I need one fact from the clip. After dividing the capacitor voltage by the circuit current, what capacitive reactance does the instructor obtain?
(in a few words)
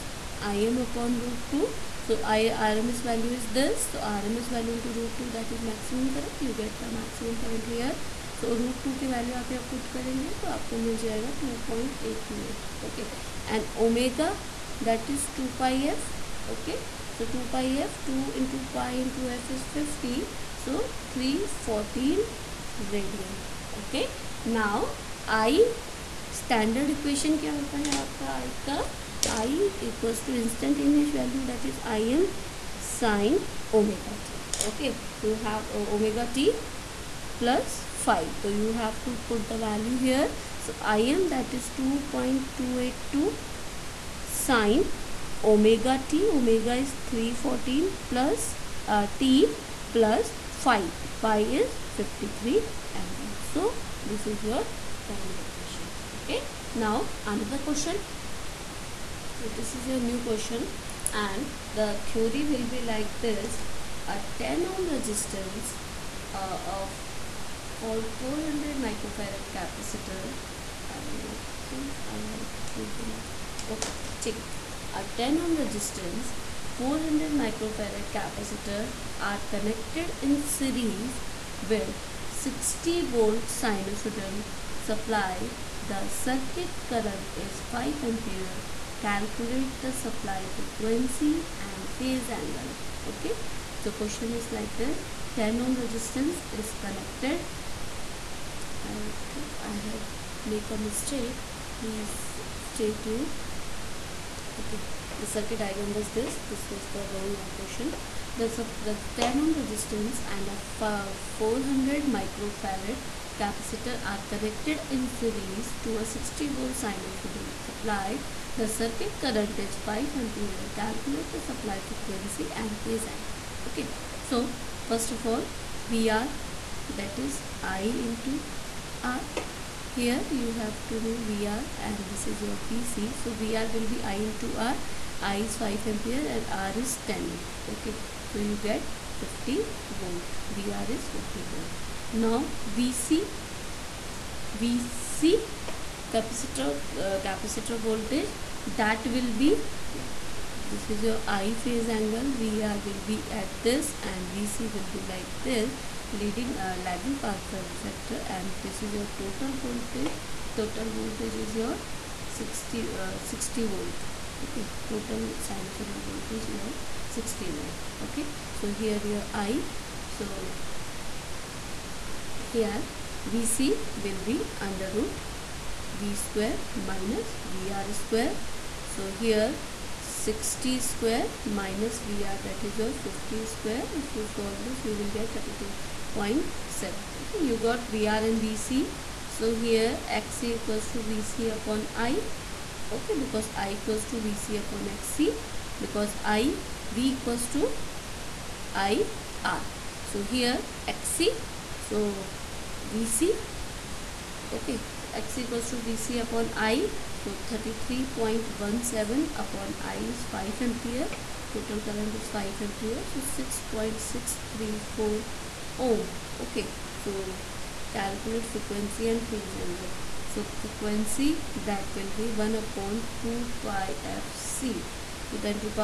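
6.634 ohm.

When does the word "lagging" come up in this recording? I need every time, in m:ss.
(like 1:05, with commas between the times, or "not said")
2:36.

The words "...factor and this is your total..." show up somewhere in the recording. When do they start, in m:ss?
2:37.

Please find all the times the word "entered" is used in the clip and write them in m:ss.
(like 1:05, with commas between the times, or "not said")
not said.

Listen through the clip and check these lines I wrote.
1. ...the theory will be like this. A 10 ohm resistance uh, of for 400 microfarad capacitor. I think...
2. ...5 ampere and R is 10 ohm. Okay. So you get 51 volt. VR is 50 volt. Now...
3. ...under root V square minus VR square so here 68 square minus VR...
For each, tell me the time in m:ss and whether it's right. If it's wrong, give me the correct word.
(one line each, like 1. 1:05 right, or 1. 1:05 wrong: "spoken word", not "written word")
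1. 1:01 right
2. 2:15 wrong: "50", not "51"
3. 2:54 wrong: "60", not "68".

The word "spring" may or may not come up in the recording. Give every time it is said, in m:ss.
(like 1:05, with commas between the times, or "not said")
not said.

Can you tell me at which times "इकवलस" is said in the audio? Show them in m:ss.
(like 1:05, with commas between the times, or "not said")
0:29.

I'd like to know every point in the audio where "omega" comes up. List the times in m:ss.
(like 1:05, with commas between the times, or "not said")
0:13.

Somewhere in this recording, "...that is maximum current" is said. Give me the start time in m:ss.
0:05.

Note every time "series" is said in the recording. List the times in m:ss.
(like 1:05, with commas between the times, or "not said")
1:20, 1:55.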